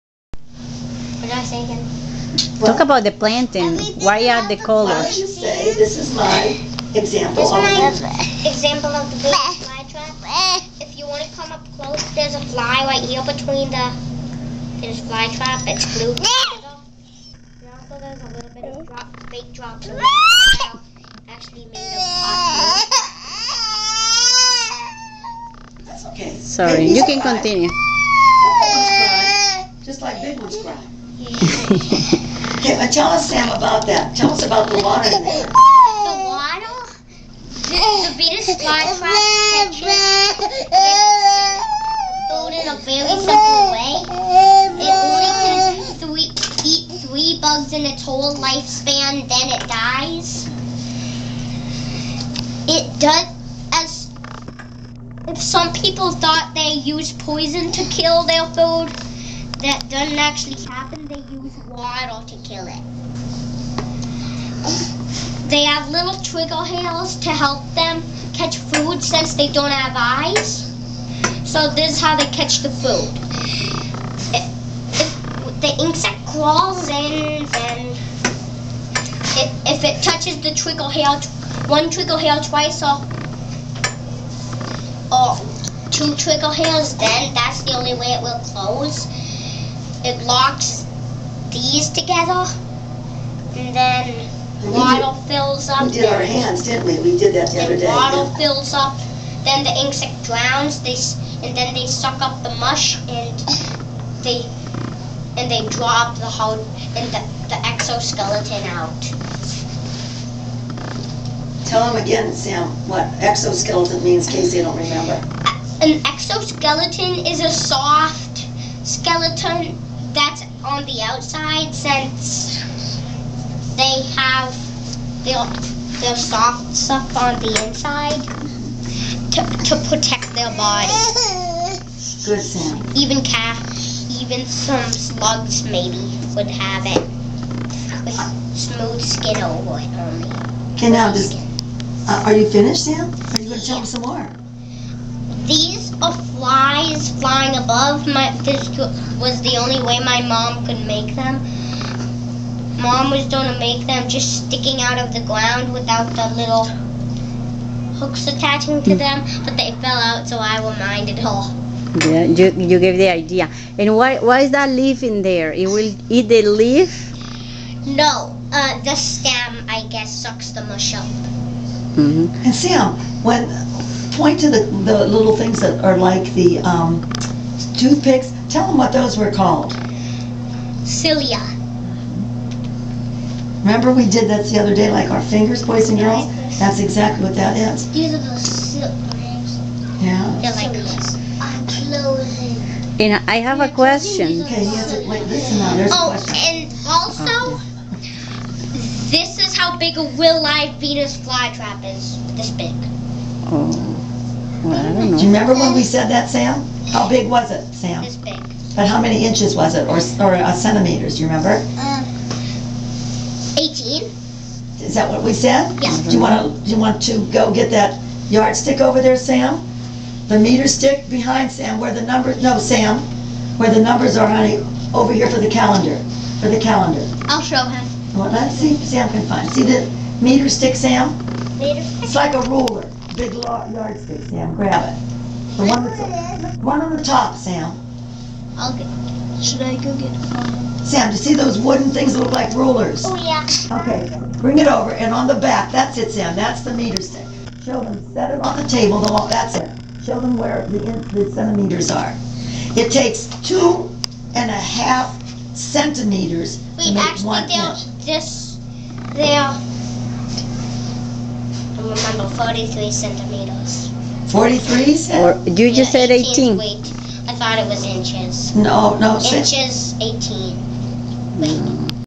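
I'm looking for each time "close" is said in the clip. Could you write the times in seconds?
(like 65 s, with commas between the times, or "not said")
11 s, 88 s.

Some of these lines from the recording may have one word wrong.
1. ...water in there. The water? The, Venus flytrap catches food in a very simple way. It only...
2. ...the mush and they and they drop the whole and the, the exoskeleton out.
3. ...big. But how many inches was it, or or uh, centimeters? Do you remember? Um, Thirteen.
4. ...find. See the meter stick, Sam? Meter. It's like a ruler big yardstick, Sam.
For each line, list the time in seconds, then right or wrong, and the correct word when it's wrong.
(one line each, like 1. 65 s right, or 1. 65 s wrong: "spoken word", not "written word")
1. 34 s right
2. 102 s right
3. 208 s wrong: "Eighteen", not "Thirteen"
4. 229 s right.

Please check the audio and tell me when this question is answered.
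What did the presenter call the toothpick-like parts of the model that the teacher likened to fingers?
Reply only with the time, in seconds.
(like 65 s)
180 s.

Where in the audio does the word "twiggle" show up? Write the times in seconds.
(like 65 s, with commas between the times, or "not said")
80 s, 86 s.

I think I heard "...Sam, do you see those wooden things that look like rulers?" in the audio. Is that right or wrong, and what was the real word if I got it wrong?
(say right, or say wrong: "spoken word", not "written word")
right.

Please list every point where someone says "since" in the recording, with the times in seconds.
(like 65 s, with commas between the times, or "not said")
69 s, 121 s.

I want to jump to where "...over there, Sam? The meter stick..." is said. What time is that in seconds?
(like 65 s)
218 s.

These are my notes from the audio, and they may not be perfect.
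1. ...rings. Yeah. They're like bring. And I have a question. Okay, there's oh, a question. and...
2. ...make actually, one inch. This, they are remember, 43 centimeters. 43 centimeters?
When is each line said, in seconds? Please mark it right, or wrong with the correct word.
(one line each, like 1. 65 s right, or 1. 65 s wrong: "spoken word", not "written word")
1. 189 s wrong: "clothing", not "bring"
2. 256 s right.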